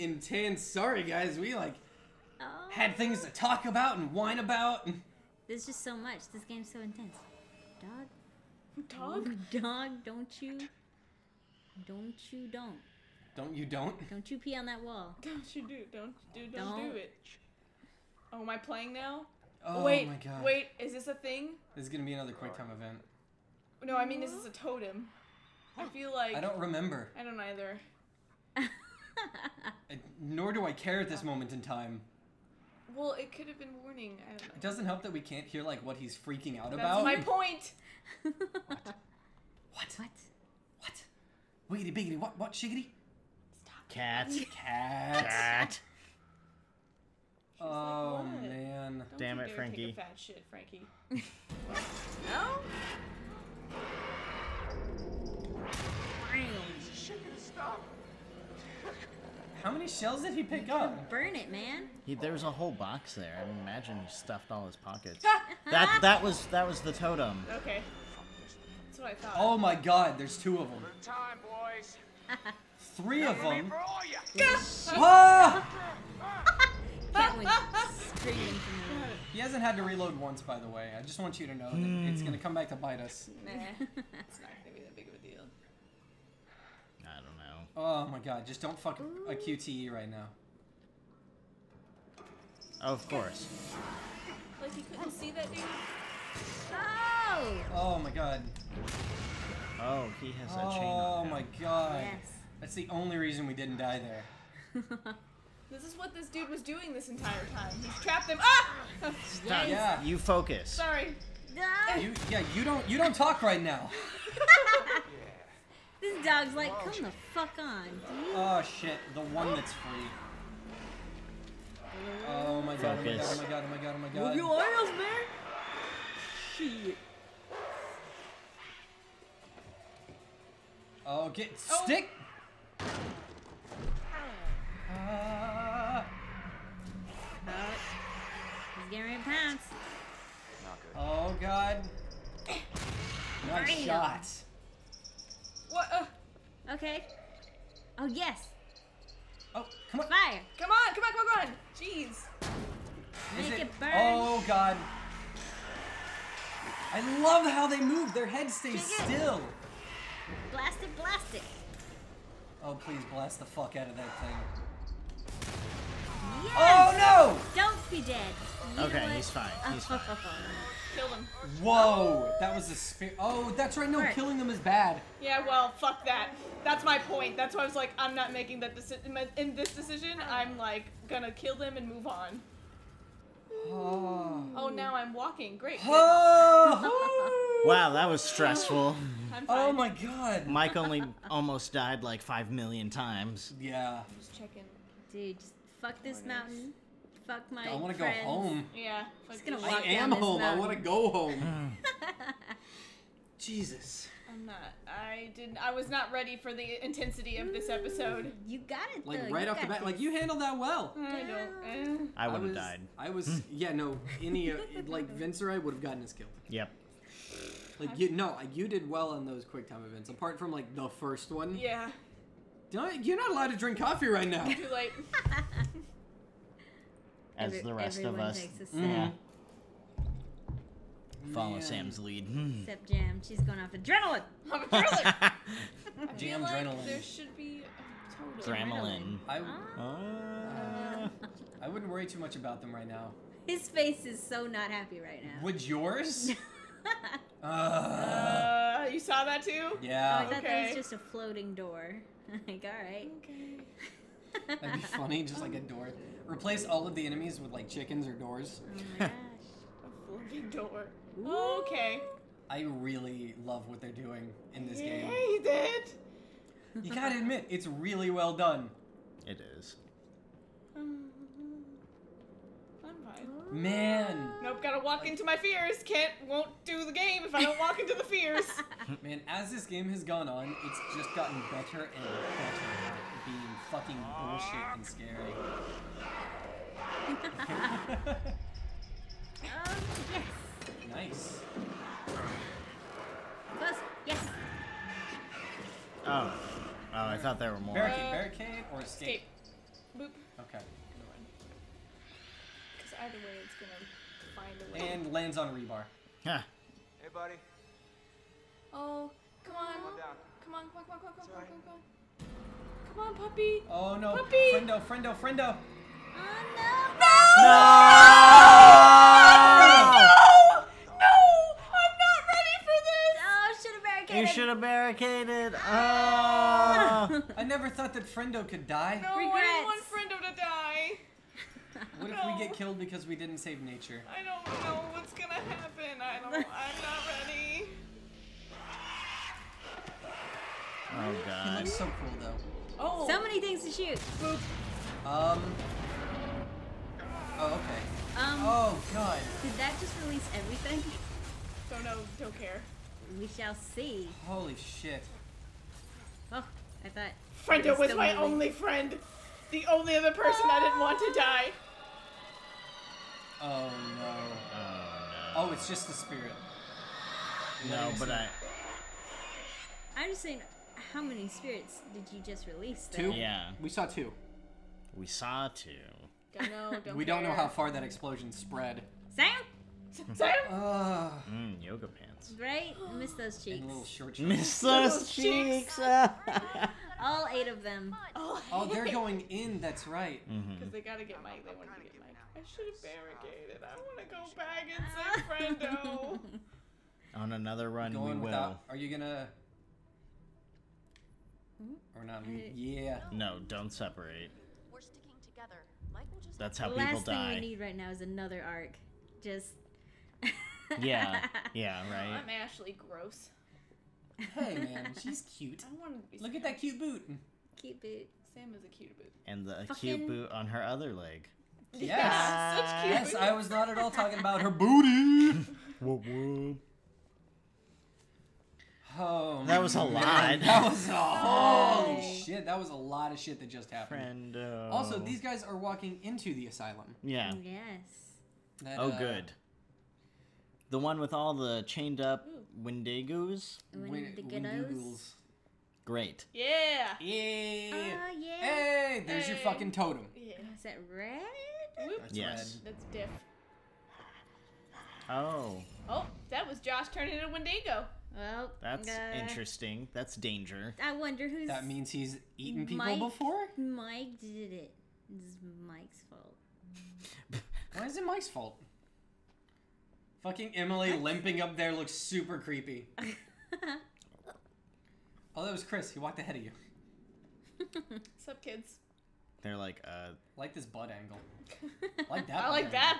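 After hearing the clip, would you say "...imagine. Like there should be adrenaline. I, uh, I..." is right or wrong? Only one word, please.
wrong.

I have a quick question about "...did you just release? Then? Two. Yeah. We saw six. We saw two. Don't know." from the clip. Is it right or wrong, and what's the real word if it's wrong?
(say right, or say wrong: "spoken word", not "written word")
wrong: "two", not "six".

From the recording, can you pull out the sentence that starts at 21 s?
This is gonna be another quick time event.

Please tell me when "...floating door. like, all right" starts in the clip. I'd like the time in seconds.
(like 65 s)
250 s.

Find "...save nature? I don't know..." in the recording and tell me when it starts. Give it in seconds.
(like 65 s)
333 s.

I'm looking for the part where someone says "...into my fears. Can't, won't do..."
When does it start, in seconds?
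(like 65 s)
275 s.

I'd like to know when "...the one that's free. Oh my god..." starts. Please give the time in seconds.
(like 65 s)
119 s.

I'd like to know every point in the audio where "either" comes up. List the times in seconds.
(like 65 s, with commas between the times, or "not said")
27 s, 303 s.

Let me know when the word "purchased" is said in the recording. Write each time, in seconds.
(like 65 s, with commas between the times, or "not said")
not said.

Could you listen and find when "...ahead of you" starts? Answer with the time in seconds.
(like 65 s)
476 s.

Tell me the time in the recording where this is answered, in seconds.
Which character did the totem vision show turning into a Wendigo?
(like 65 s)
456 s.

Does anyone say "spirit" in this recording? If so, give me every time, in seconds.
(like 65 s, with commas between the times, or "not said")
365 s, 371 s.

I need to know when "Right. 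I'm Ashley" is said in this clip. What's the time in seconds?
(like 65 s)
411 s.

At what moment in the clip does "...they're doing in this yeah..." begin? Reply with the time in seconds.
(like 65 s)
263 s.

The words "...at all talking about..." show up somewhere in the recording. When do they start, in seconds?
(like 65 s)
423 s.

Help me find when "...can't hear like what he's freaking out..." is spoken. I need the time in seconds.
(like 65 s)
35 s.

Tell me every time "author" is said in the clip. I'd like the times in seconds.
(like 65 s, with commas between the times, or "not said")
not said.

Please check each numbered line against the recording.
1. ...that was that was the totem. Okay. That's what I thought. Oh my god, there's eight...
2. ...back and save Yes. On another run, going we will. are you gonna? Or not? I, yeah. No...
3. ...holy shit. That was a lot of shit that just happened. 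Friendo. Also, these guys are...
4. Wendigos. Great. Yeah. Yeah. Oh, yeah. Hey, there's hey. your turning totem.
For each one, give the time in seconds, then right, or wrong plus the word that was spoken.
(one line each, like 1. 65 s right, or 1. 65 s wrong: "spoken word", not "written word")
1. 66 s wrong: "two", not "eight"
2. 394 s wrong: "Friendo", not "Yes"
3. 430 s right
4. 443 s wrong: "fucking", not "turning".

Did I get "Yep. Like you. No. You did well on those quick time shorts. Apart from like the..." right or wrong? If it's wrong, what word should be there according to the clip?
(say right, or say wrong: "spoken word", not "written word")
wrong: "events", not "shorts".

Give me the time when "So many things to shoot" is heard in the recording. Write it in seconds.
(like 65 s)
343 s.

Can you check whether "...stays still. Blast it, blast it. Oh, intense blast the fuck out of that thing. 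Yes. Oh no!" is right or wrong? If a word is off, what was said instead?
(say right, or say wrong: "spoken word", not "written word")
wrong: "please", not "intense".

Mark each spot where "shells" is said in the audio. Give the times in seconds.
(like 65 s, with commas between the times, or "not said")
59 s.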